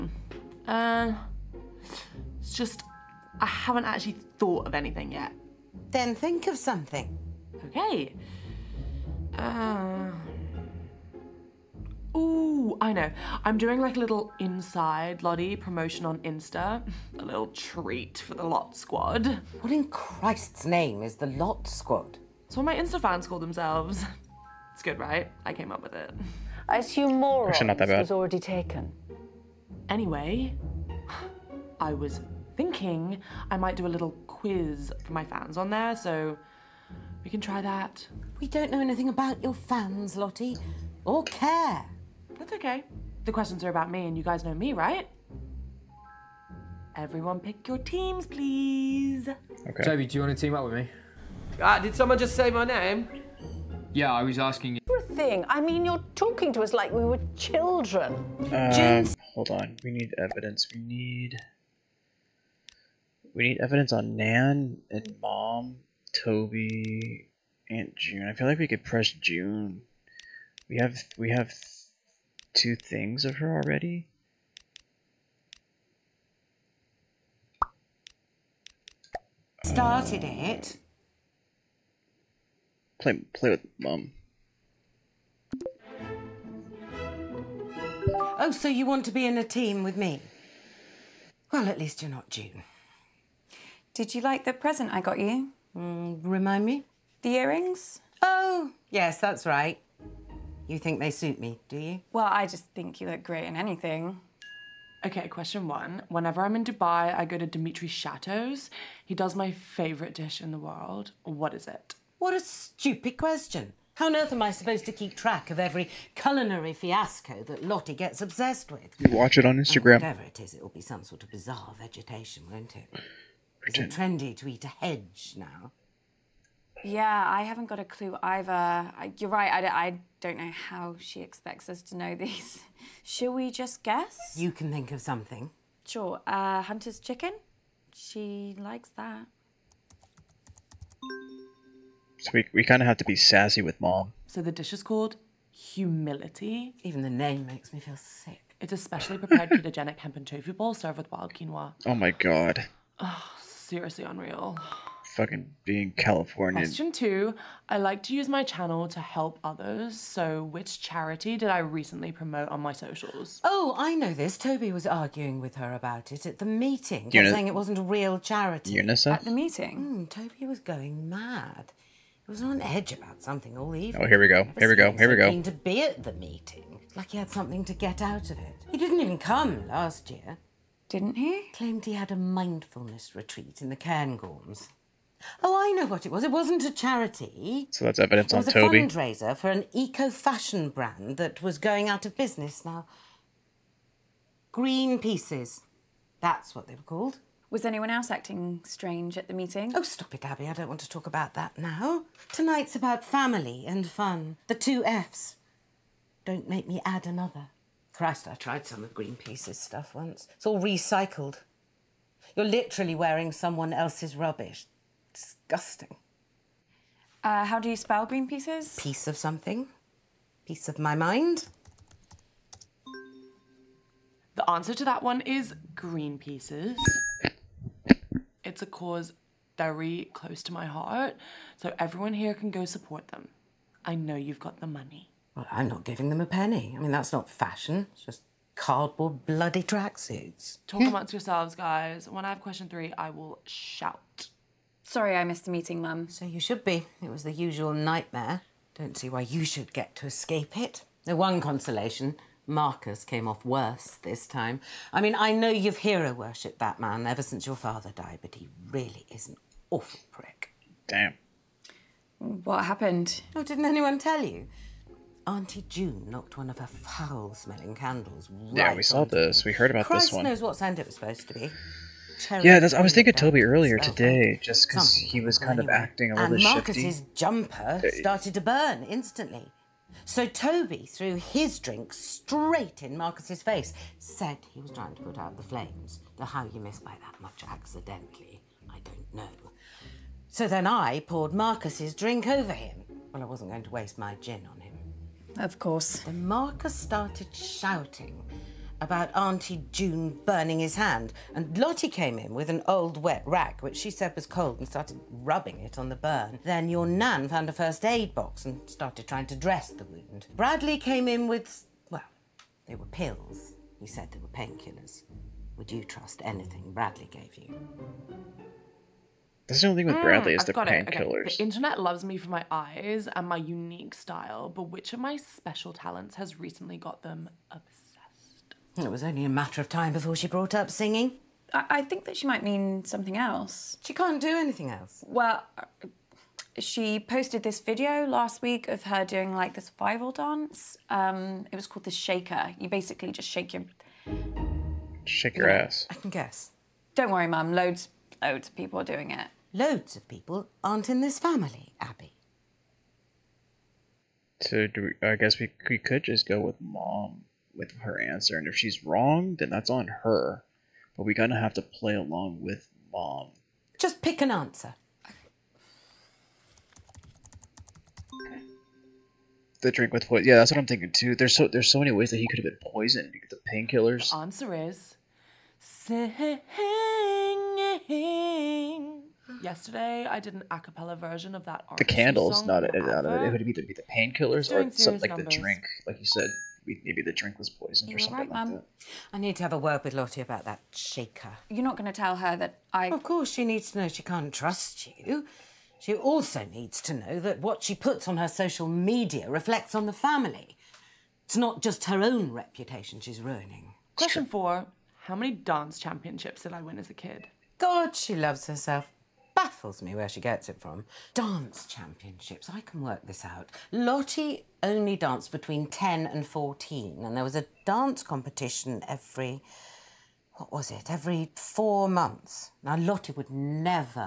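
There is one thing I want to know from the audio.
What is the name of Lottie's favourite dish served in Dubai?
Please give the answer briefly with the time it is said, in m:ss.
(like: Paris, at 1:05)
Humility, at 2:25.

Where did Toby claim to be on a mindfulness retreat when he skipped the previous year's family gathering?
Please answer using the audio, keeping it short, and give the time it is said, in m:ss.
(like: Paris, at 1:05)
The Cairngorms, at 3:03.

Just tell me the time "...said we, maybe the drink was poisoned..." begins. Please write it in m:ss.
6:26.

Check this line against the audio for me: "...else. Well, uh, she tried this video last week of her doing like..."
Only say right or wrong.
wrong.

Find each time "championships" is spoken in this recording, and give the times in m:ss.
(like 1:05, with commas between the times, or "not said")
6:45, 6:51.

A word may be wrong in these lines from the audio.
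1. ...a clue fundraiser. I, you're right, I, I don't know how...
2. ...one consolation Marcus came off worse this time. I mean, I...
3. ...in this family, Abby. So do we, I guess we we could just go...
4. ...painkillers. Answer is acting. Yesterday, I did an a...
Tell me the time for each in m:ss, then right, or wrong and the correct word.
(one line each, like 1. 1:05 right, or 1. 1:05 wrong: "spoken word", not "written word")
1. 2:07 wrong: "either", not "fundraiser"
2. 4:11 right
3. 5:50 right
4. 6:13 wrong: "singing", not "acting".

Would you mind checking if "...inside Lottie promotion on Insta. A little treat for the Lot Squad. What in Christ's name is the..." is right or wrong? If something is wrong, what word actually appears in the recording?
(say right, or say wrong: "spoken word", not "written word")
right.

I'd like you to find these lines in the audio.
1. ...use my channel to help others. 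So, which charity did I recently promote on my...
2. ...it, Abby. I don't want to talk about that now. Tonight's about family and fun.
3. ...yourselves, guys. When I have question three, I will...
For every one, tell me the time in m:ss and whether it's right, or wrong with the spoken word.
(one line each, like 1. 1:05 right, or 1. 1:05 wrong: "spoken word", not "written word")
1. 2:38 right
2. 3:20 right
3. 4:01 right.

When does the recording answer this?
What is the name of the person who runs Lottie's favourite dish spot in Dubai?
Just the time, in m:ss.
1:47.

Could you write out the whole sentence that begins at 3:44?
The answer to that one is Green Pieces.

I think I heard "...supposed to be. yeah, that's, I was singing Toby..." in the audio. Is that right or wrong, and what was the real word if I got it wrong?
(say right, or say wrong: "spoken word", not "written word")
wrong: "thinking", not "singing".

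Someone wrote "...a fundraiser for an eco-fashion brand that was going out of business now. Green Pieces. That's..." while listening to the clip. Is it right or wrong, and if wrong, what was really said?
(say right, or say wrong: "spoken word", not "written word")
right.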